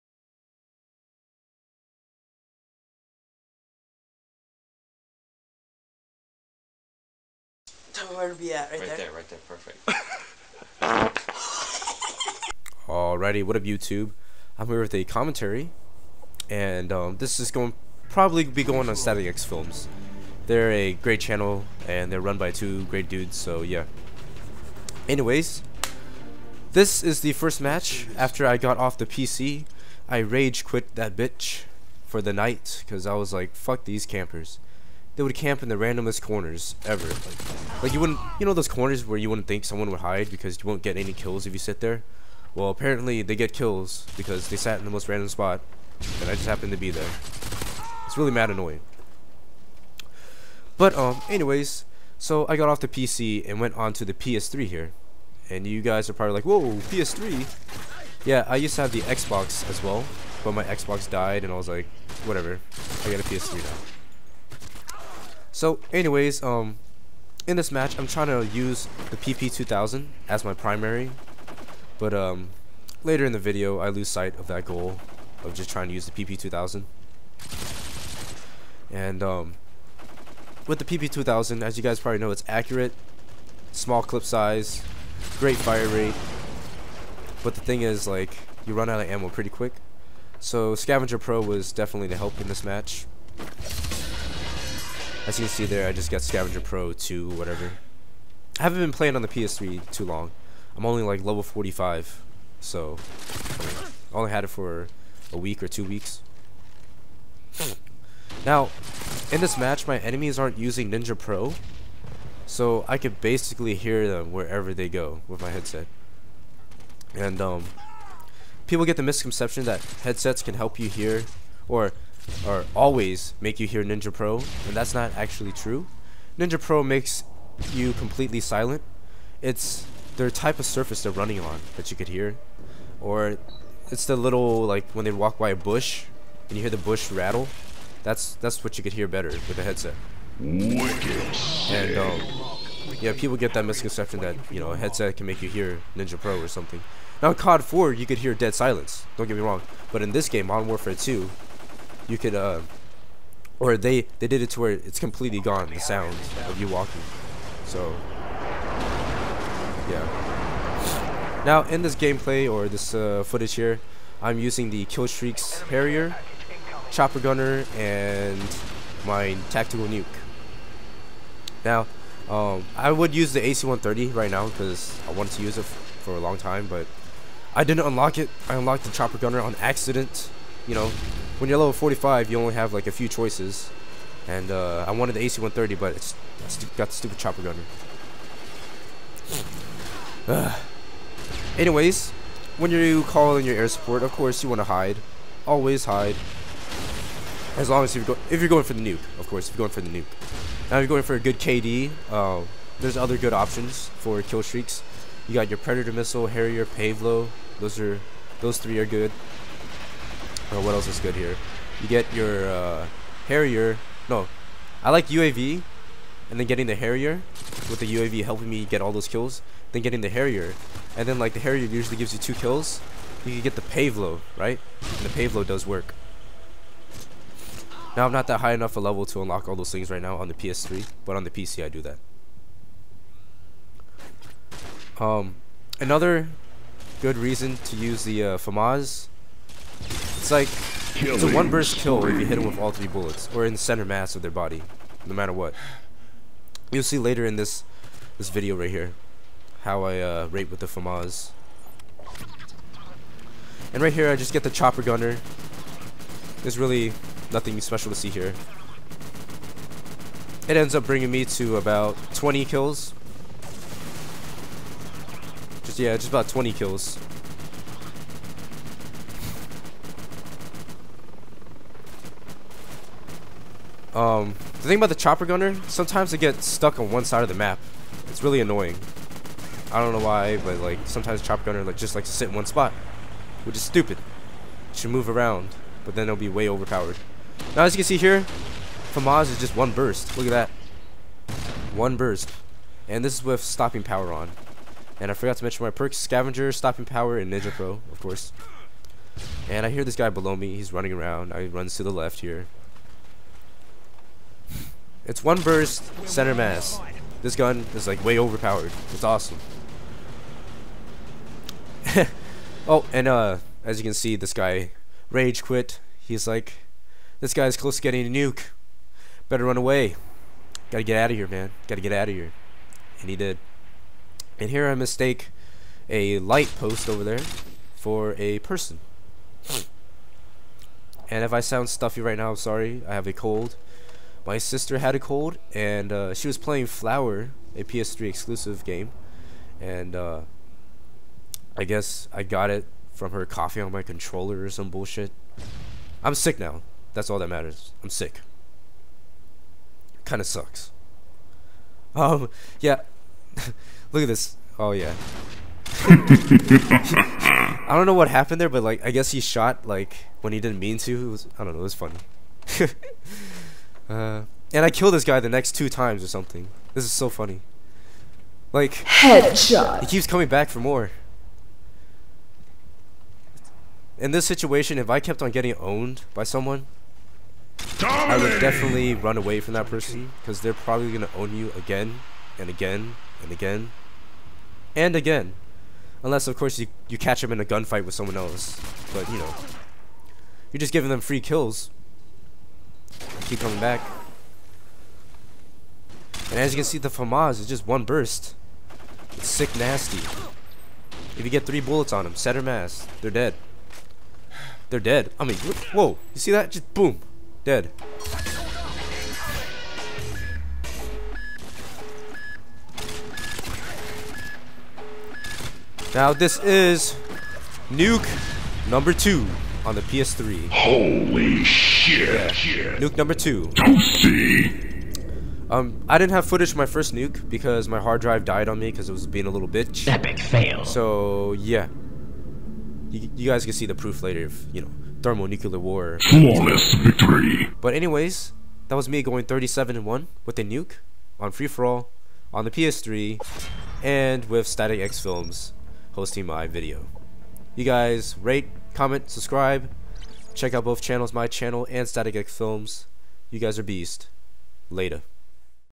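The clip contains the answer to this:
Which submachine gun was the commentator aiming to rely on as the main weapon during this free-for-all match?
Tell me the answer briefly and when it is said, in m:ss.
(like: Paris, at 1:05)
PP2000, at 1:09.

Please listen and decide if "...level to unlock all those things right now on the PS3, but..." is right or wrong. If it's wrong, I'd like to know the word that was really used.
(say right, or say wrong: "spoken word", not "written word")
right.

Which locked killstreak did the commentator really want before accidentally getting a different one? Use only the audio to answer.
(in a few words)
AC-130.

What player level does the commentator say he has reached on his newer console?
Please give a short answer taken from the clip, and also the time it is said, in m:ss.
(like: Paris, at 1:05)
45, at 1:40.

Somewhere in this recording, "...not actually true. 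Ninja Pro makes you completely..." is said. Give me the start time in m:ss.
2:04.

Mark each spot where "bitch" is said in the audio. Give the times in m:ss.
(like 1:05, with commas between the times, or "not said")
0:31, 7:09.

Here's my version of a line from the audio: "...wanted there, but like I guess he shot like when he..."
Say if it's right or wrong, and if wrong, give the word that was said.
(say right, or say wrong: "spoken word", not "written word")
wrong: "happened", not "wanted".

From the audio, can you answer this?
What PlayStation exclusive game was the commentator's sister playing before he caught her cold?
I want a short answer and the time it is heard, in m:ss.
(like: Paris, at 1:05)
Flower, at 5:36.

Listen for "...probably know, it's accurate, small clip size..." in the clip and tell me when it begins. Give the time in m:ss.
1:21.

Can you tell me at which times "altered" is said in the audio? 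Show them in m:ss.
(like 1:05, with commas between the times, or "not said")
not said.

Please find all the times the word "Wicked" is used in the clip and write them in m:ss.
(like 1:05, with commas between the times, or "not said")
2:20.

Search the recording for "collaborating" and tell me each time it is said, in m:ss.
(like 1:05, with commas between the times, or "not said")
not said.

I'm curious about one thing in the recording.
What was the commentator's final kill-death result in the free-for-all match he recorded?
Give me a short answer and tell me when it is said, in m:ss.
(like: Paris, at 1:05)
37 and 1, at 7:19.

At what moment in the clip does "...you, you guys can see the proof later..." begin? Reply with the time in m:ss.
7:12.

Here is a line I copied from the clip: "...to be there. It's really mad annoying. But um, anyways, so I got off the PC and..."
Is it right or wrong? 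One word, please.
right.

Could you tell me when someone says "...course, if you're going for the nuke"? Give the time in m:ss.
3:19.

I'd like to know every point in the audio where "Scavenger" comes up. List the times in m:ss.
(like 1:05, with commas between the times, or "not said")
1:30, 1:36, 4:55.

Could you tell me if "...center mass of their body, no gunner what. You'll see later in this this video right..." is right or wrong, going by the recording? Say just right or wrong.
wrong.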